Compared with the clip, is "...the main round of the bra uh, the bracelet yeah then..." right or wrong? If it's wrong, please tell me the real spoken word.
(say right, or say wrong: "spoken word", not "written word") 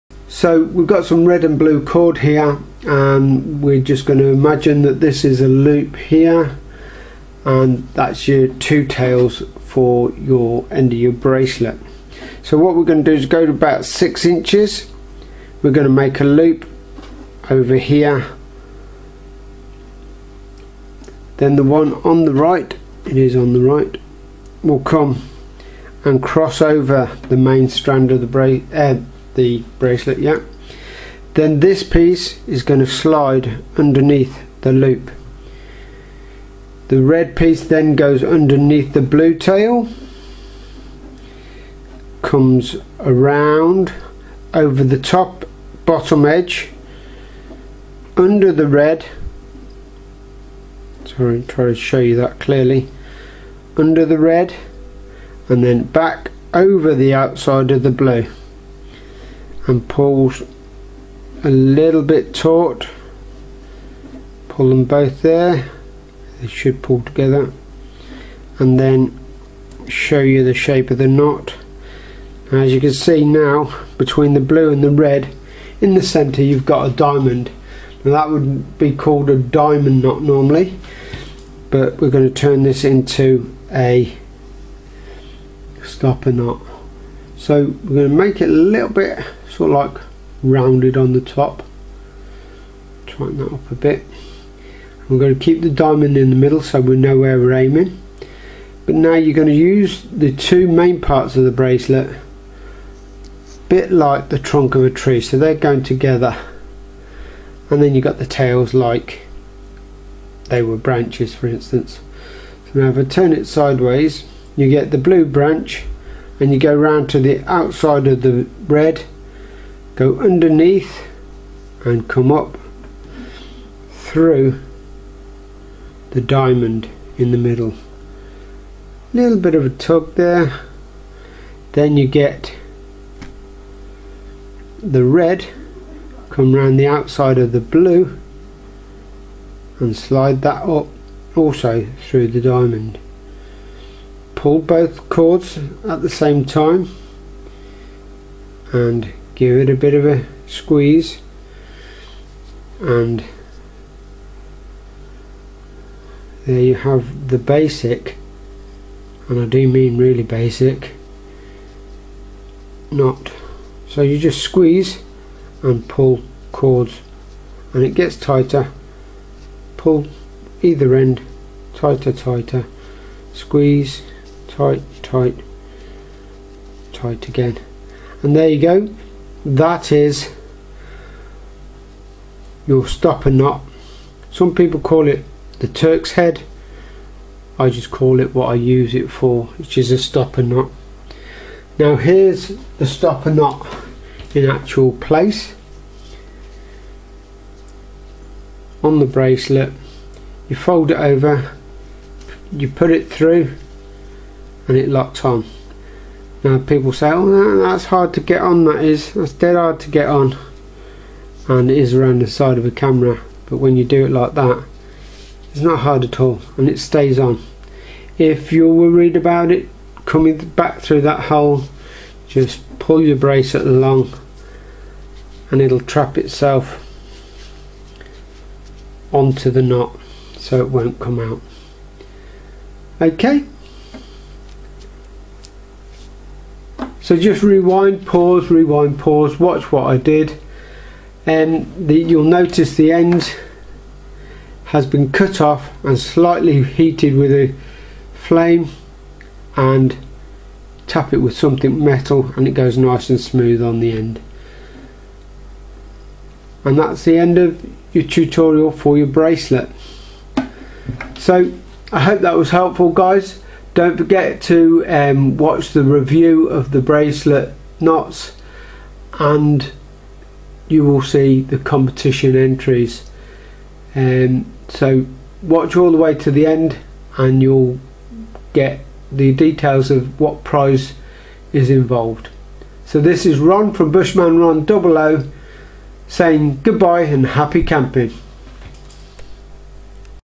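wrong: "strand", not "round".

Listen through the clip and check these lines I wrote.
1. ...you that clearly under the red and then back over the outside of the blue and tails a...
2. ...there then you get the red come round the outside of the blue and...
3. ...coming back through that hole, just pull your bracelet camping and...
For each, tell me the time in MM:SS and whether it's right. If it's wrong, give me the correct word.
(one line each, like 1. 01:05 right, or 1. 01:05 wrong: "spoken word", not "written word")
1. 00:51 wrong: "pulls", not "tails"
2. 02:10 right
3. 03:40 wrong: "along", not "camping".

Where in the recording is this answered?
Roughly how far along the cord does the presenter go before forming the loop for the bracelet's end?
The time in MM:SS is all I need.
00:13.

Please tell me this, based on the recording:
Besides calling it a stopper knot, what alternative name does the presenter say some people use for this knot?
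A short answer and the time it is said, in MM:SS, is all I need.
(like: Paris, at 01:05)
Turk's head, at 03:05.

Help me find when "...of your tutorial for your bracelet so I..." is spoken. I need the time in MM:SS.
04:17.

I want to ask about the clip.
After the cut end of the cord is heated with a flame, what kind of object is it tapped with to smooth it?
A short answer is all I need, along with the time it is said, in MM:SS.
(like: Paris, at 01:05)
something metal, at 04:11.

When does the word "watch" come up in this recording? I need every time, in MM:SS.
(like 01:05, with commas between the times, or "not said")
03:59, 04:25, 04:35.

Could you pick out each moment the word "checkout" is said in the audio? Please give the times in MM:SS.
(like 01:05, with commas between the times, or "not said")
not said.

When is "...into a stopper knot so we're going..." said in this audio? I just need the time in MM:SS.
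01:22.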